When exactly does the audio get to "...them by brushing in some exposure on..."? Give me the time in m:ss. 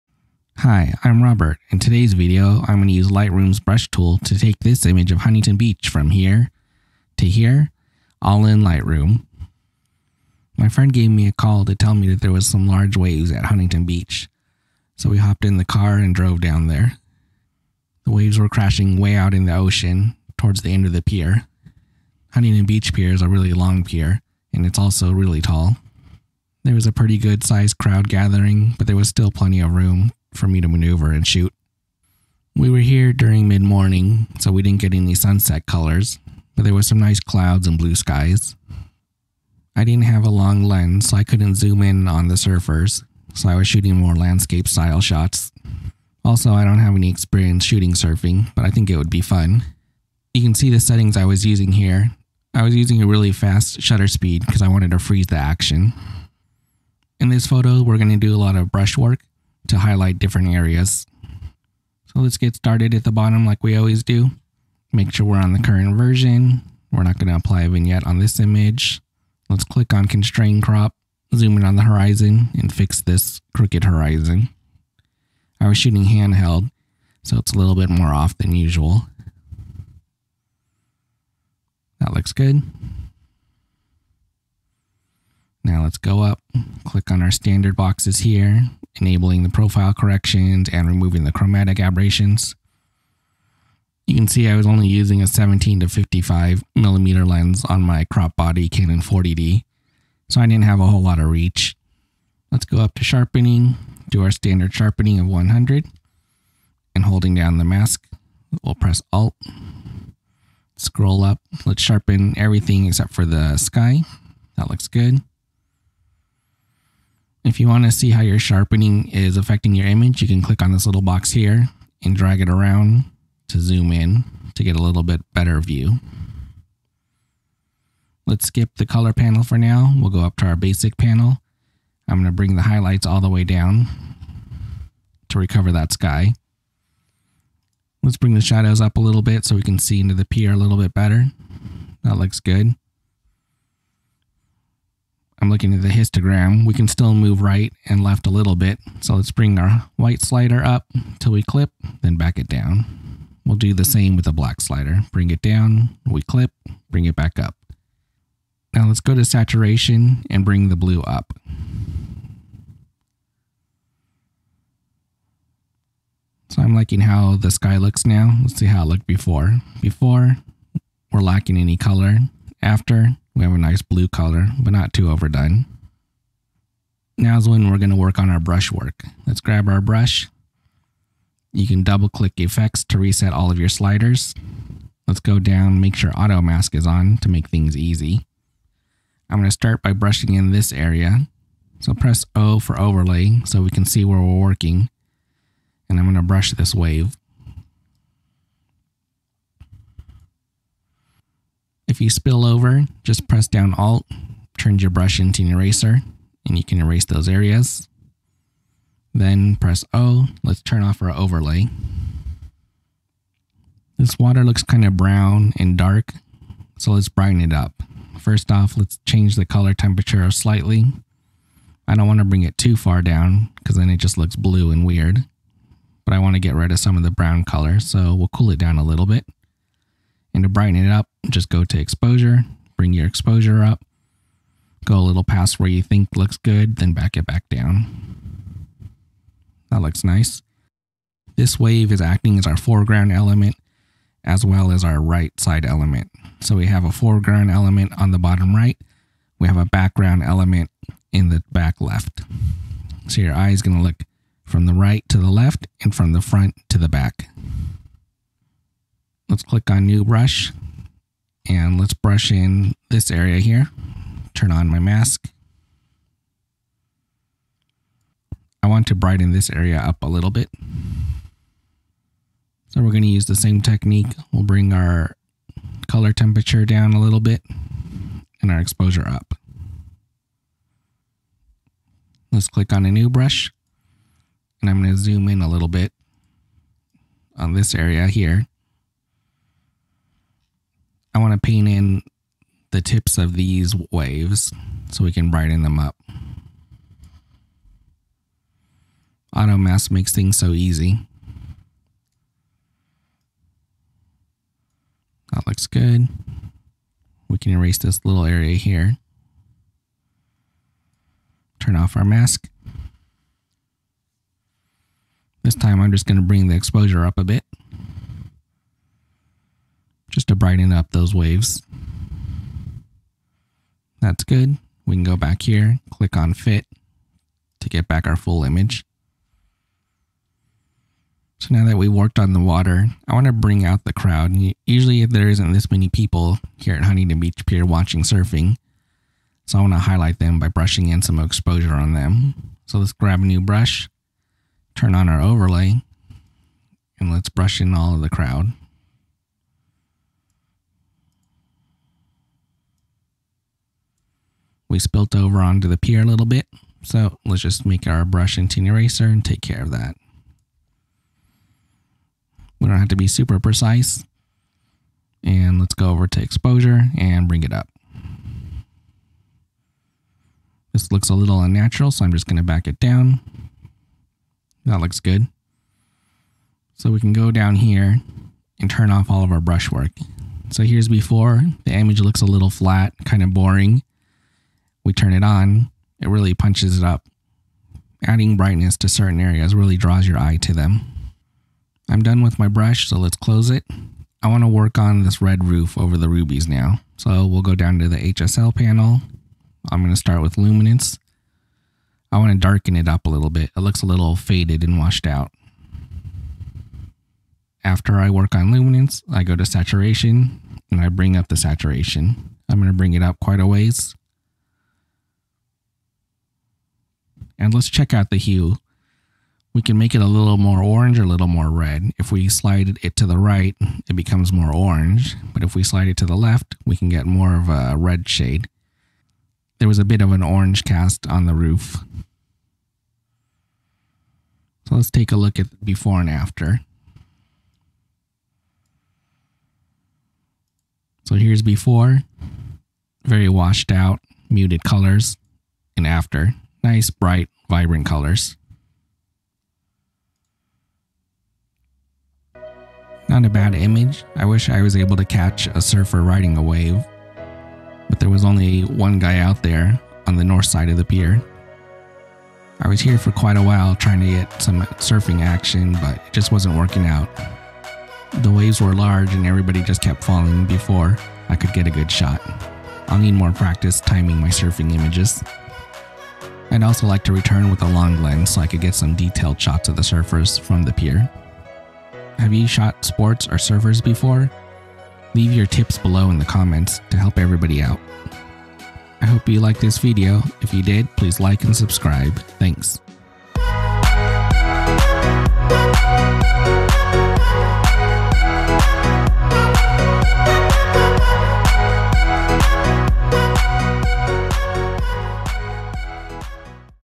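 5:40.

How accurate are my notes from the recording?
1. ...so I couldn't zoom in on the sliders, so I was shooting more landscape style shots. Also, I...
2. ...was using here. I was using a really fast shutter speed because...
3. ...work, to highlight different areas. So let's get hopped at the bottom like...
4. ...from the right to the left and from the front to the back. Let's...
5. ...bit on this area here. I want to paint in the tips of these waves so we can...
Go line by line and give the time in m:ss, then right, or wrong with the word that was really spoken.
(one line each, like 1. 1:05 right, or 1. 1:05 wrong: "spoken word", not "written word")
1. 0:41 wrong: "surfers", not "sliders"
2. 0:51 right
3. 0:58 wrong: "started", not "hopped"
4. 4:14 right
5. 4:45 right.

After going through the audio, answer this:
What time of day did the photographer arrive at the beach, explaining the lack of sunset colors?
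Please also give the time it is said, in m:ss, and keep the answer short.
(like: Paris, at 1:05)
mid morning, at 0:33.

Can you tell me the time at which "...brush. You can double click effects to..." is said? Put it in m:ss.
2:59.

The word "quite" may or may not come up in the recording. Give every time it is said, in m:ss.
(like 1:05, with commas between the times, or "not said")
6:53, 7:43.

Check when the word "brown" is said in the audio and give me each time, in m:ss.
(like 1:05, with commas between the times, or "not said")
3:34, 3:47.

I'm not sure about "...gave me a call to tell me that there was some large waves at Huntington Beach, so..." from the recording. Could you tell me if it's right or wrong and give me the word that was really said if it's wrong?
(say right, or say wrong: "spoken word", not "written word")
right.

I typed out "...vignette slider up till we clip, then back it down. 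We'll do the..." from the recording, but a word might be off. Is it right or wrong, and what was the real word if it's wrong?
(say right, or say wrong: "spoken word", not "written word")
wrong: "white", not "vignette".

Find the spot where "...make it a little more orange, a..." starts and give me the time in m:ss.
6:59.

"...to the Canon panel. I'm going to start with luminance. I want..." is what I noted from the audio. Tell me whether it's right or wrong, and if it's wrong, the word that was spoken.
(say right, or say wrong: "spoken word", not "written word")
wrong: "HSL", not "Canon".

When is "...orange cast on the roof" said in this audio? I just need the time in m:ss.
7:10.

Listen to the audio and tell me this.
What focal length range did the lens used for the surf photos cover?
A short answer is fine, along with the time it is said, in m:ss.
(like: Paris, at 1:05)
17 to 55 millimeter, at 1:35.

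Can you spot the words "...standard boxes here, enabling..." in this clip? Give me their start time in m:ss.
1:27.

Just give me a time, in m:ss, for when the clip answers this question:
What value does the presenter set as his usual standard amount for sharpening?
1:45.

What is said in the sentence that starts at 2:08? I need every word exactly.
Let's skip the color panel for now.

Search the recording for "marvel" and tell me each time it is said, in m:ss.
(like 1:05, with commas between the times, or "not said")
not said.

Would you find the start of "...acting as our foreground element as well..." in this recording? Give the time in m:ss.
4:02.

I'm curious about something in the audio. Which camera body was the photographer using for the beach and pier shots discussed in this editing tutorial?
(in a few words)
Canon 40D.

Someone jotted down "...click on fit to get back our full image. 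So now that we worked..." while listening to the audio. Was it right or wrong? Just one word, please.
right.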